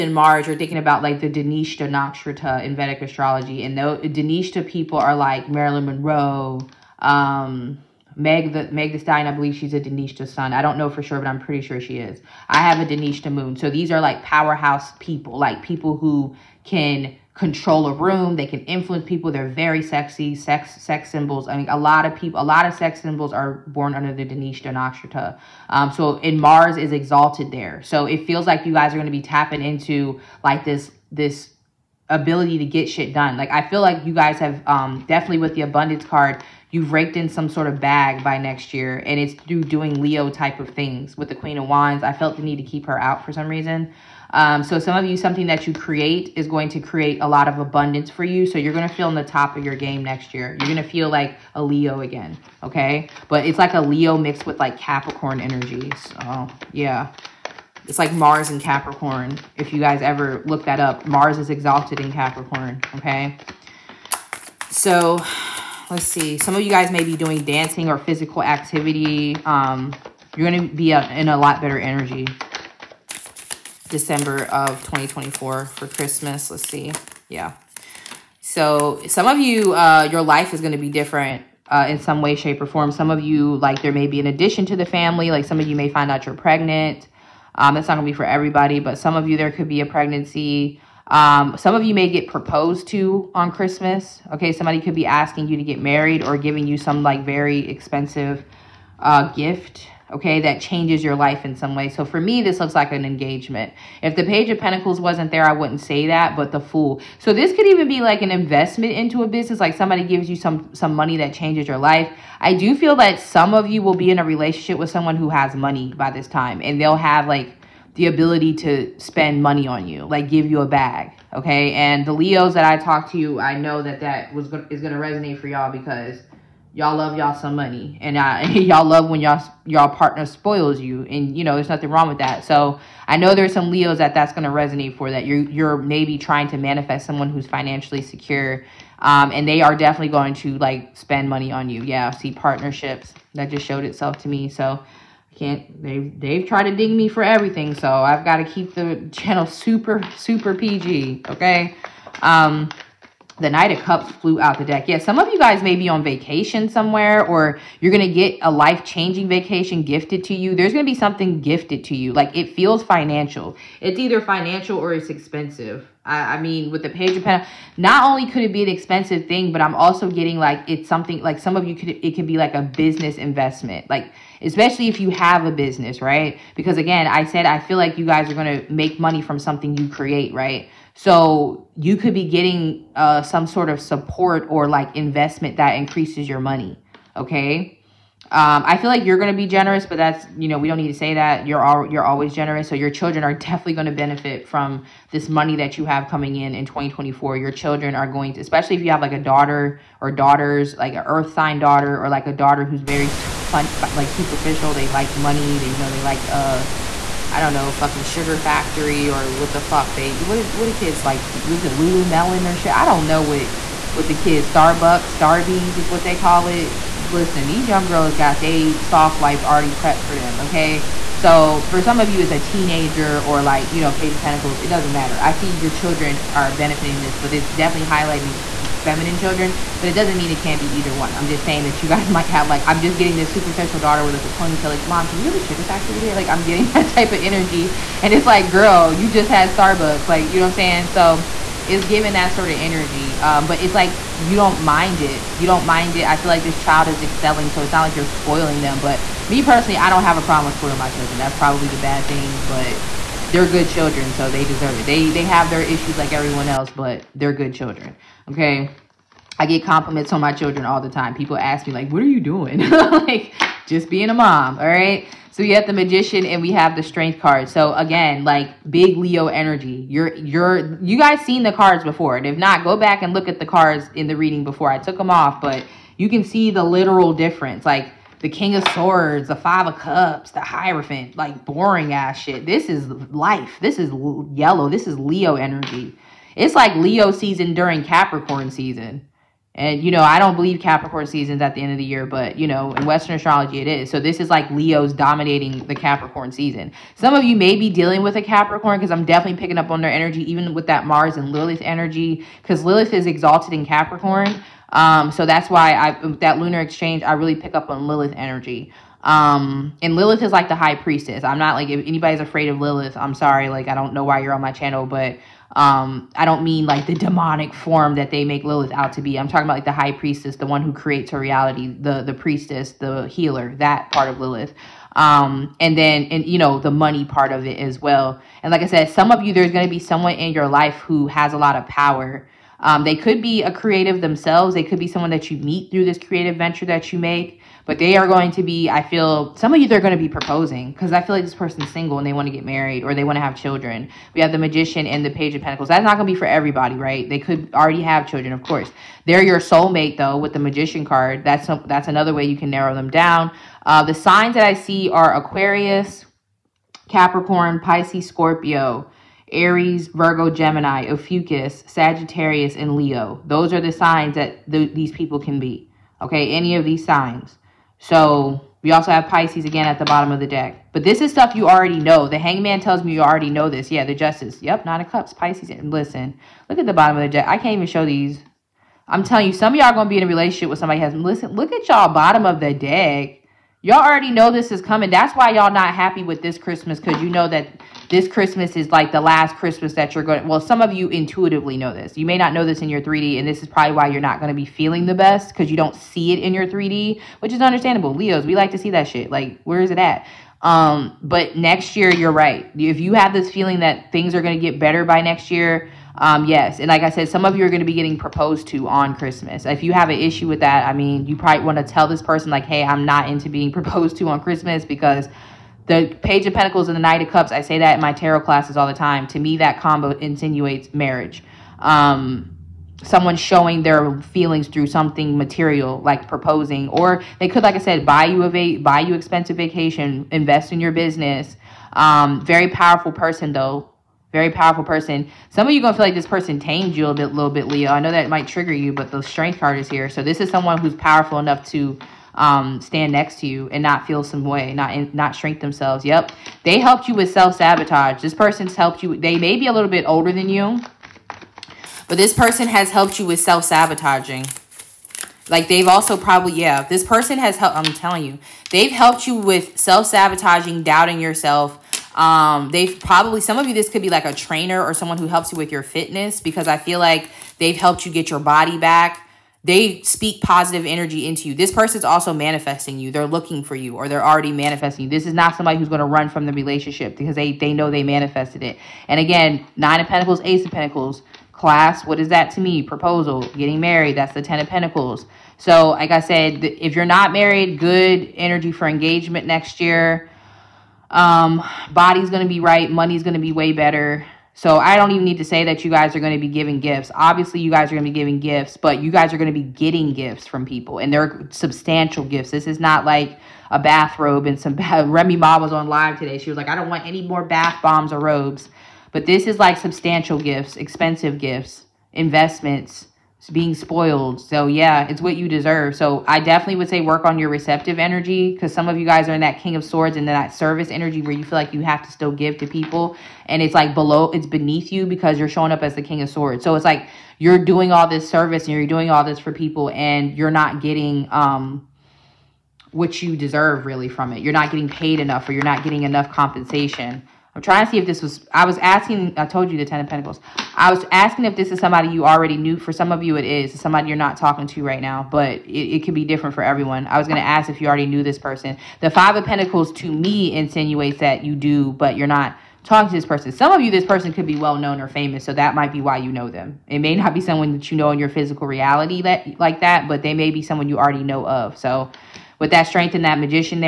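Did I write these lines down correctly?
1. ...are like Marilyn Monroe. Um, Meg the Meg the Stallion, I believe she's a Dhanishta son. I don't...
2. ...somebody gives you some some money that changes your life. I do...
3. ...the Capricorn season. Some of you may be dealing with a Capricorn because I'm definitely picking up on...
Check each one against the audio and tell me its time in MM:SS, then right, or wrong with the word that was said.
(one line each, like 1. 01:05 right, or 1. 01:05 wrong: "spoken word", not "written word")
1. 00:04 right
2. 01:49 right
3. 04:55 right.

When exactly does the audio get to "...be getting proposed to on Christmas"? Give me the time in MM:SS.
06:47.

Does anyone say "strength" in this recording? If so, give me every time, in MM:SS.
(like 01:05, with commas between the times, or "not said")
04:26, 07:19, 09:22.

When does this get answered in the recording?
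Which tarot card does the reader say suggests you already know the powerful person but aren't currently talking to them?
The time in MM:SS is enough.
09:08.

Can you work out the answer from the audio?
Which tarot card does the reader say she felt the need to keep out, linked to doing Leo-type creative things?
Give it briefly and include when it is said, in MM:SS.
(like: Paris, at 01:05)
Queen of Wands, at 00:41.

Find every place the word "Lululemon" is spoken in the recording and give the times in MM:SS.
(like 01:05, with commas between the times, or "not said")
03:31.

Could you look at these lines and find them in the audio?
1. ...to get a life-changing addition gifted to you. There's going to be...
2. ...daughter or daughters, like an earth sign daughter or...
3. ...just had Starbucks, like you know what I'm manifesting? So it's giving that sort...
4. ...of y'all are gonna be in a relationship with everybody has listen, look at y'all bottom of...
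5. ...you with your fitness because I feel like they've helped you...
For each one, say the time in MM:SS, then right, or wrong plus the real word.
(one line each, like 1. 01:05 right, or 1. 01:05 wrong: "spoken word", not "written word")
1. 02:38 wrong: "vacation", not "addition"
2. 03:19 right
3. 03:59 wrong: "saying", not "manifesting"
4. 06:19 wrong: "somebody", not "everybody"
5. 07:45 right.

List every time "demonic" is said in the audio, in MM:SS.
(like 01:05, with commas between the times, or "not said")
05:16.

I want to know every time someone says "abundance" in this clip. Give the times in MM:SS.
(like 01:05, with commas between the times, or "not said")
00:35, 00:47.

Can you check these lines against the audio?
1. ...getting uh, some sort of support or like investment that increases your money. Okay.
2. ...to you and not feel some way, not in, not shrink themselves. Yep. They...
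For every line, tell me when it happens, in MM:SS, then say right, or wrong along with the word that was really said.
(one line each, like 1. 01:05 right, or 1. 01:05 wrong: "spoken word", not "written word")
1. 03:02 right
2. 07:23 right.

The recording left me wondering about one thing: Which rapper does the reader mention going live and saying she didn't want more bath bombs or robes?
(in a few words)
Remy Ma.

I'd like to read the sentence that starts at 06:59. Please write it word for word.
To me, that combo insinuates marriage.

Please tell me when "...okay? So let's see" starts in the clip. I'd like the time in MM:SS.
01:02.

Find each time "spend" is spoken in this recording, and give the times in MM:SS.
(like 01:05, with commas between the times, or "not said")
01:58, 02:20.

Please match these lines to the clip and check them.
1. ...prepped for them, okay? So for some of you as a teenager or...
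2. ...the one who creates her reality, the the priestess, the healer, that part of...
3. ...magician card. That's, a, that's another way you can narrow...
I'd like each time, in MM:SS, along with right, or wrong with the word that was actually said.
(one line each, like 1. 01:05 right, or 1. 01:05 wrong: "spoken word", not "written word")
1. 03:39 right
2. 05:20 right
3. 05:50 right.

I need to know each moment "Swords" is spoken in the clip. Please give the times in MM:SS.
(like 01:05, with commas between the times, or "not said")
04:38, 08:39, 08:46.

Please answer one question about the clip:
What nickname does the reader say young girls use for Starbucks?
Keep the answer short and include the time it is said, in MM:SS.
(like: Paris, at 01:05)
Starbies, at 03:35.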